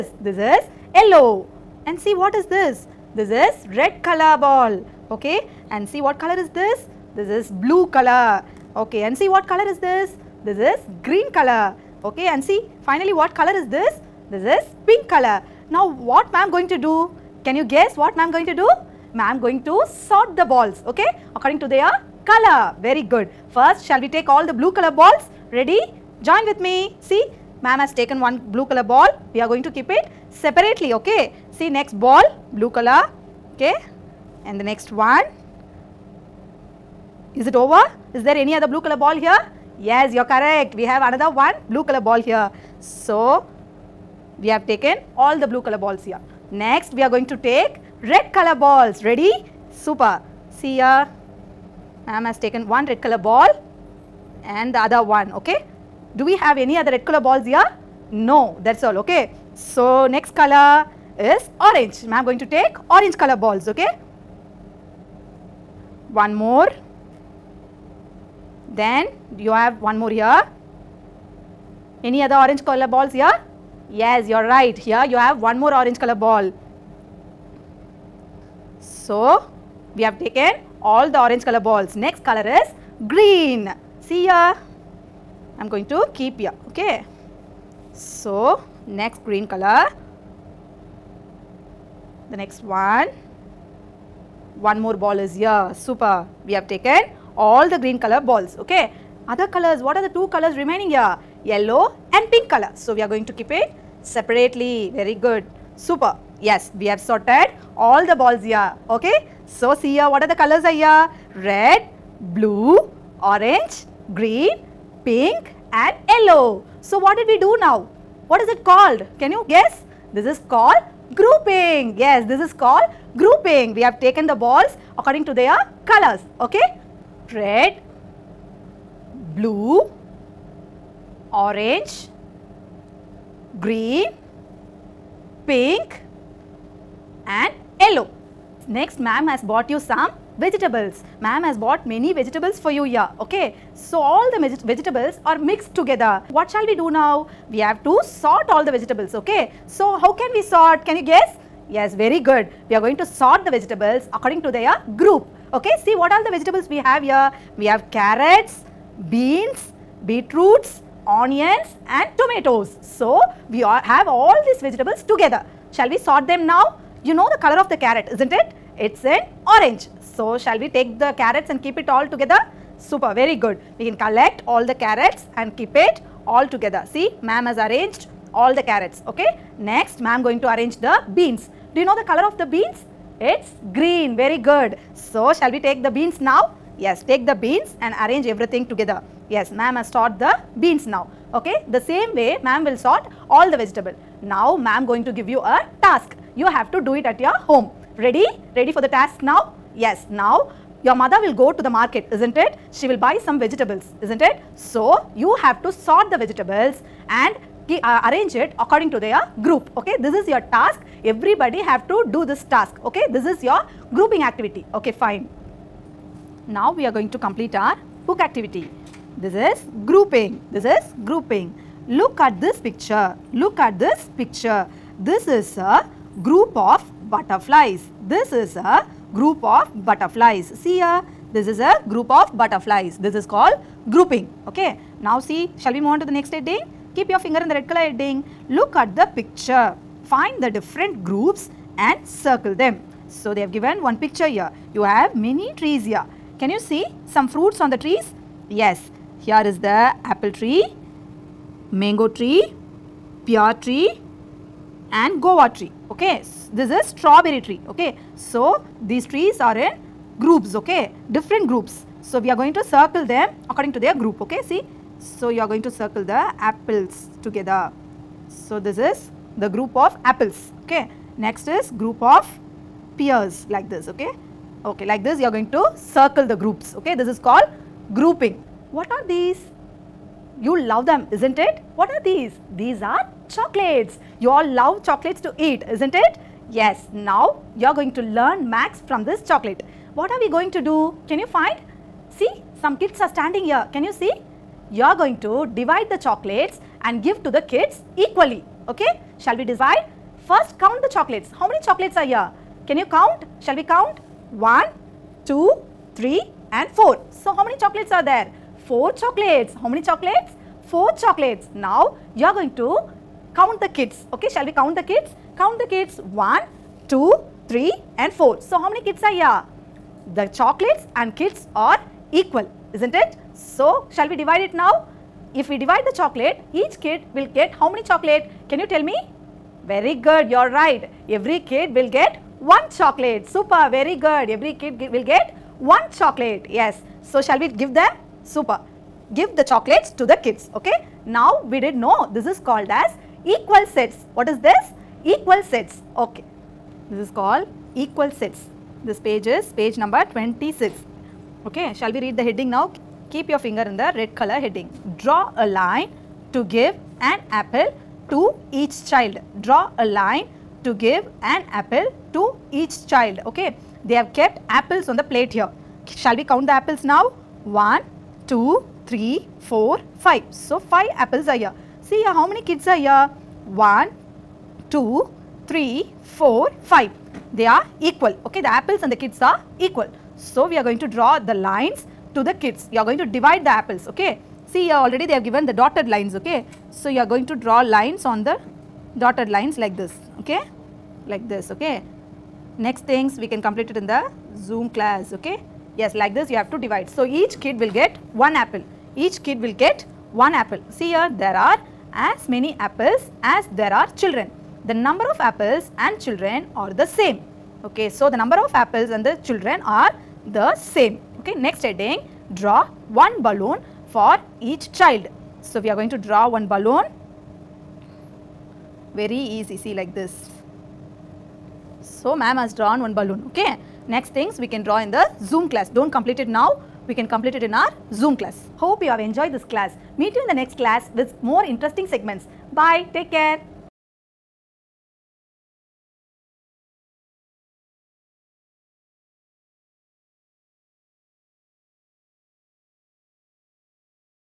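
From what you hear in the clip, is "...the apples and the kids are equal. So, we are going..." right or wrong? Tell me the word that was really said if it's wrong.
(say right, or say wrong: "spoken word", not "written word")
right.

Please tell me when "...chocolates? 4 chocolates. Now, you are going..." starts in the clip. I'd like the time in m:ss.
5:09.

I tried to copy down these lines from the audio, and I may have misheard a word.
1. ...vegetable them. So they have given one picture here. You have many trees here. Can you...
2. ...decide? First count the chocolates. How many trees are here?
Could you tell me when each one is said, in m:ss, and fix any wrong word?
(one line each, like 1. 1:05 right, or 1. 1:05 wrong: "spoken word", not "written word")
1. 4:02 wrong: "circle", not "vegetable"
2. 4:59 wrong: "chocolates", not "trees".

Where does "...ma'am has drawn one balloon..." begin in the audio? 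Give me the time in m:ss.
7:02.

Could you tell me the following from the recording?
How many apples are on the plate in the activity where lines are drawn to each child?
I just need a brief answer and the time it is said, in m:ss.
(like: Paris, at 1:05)
5, at 6:10.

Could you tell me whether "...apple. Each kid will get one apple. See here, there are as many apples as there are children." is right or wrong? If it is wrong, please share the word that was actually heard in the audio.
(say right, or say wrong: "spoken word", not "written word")
right.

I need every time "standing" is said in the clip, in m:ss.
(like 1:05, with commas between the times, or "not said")
4:53.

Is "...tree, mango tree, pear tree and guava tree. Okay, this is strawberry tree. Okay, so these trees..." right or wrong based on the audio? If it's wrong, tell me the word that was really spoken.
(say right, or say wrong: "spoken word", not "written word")
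right.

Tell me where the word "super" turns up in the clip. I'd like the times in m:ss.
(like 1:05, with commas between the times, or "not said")
0:49, 1:35, 1:45, 2:52, 5:33, 5:38.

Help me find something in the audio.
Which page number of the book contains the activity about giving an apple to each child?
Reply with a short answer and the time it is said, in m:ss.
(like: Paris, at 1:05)
26, at 5:49.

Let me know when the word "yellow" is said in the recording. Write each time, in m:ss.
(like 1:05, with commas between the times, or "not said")
0:00, 1:41, 1:56, 2:17.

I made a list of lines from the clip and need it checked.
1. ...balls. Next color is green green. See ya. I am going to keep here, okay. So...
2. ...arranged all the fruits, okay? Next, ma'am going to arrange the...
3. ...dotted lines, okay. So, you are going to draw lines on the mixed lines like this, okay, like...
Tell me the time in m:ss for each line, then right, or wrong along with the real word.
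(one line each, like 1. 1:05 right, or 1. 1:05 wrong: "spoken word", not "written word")
1. 1:21 right
2. 2:57 wrong: "carrots", not "fruits"
3. 6:25 wrong: "dotted", not "mixed".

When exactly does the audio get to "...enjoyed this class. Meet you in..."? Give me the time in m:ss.
7:08.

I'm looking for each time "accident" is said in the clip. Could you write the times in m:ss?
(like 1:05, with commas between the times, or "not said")
not said.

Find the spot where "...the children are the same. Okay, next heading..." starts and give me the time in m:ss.
6:49.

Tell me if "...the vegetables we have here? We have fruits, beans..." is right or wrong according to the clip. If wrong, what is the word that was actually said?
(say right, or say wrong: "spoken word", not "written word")
wrong: "carrots", not "fruits".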